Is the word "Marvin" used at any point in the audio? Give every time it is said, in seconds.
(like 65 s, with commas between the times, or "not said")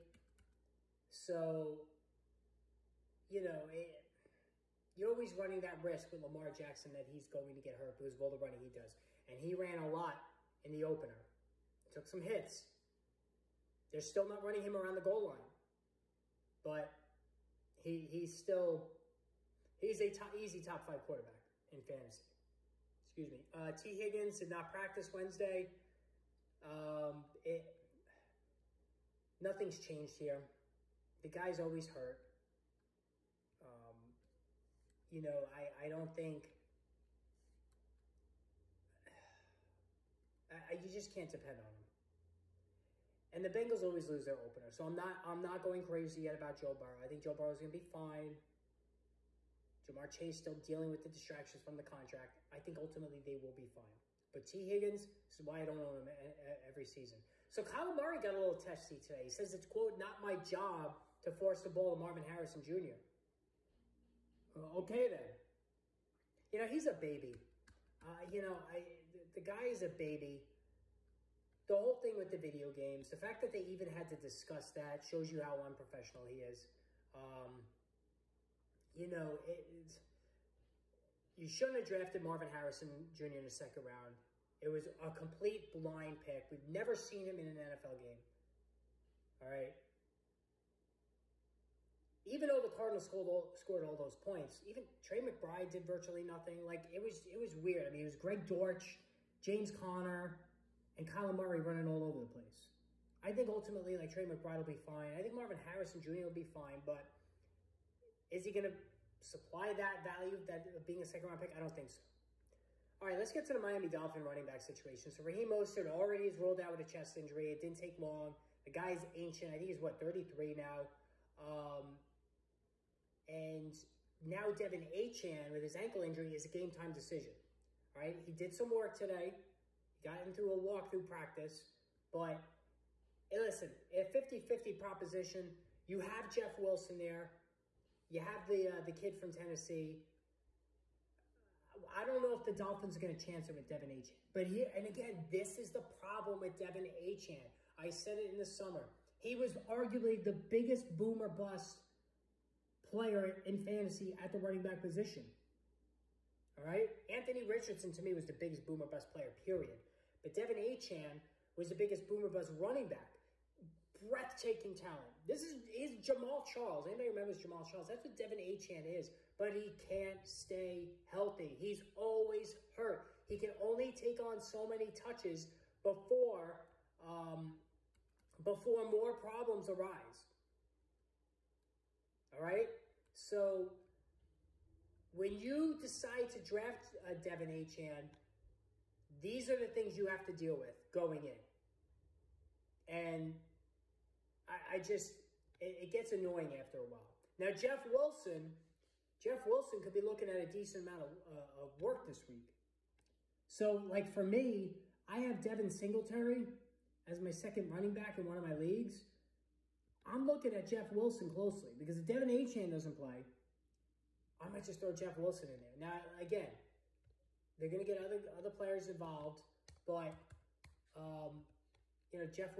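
61 s, 82 s, 105 s.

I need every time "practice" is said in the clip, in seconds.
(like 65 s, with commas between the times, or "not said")
24 s, 131 s.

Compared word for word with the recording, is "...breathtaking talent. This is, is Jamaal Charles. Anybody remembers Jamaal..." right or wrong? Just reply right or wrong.
right.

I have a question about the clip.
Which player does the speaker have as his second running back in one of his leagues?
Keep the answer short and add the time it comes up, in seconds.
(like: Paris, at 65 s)
Devin Singletary, at 205 s.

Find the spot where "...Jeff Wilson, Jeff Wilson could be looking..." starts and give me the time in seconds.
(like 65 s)
197 s.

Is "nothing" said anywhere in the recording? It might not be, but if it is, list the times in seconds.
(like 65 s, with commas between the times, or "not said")
29 s, 96 s.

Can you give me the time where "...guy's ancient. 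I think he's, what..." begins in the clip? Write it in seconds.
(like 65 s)
118 s.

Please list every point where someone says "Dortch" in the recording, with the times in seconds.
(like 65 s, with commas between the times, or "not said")
98 s.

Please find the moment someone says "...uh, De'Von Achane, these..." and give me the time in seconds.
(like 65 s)
187 s.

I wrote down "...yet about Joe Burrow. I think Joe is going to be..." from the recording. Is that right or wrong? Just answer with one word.
right.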